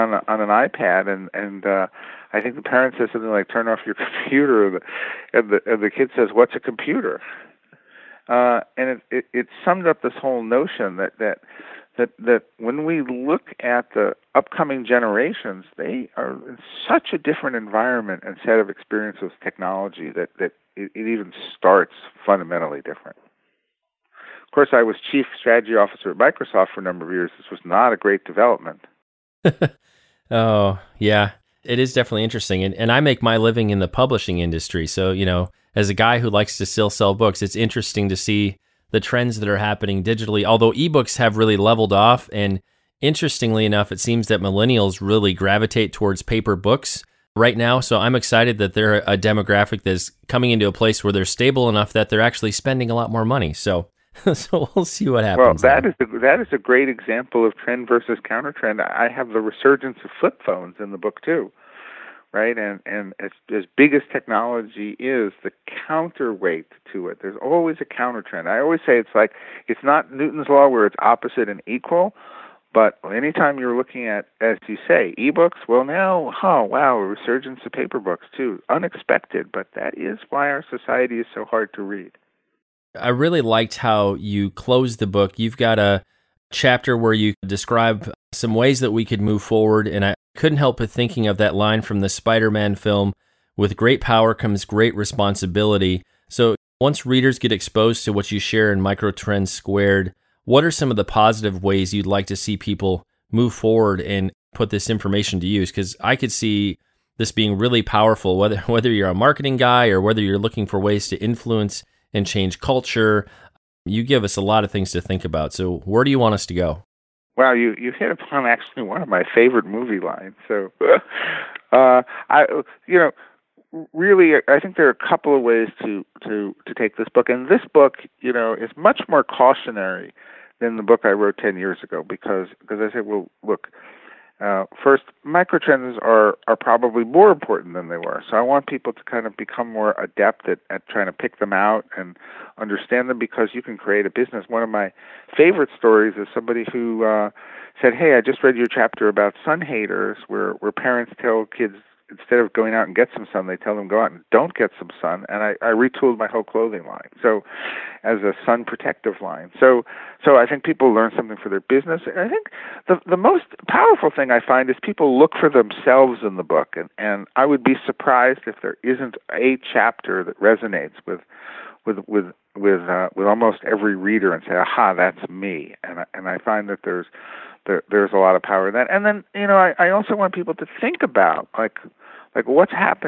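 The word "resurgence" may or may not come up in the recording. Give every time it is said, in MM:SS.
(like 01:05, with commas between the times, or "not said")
00:59, 01:17.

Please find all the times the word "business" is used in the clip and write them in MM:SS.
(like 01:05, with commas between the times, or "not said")
02:24, 02:41.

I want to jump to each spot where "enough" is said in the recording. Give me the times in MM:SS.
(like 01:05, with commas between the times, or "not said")
00:43, 00:51.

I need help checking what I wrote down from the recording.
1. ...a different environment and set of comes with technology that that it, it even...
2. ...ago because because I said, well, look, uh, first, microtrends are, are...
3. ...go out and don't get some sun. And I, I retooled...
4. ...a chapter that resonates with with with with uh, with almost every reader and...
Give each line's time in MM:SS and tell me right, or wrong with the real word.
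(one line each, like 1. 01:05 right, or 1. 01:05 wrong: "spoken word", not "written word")
1. 00:17 wrong: "experiences", not "comes"
2. 02:11 right
3. 02:33 right
4. 02:49 right.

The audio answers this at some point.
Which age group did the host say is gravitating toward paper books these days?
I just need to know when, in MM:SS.
00:44.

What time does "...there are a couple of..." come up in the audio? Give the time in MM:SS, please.
02:04.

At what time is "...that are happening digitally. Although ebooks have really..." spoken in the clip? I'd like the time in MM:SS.
00:39.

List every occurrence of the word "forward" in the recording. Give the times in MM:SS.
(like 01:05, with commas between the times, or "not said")
01:29, 01:43.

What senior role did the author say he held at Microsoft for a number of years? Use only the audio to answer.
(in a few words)
Chief strategy officer.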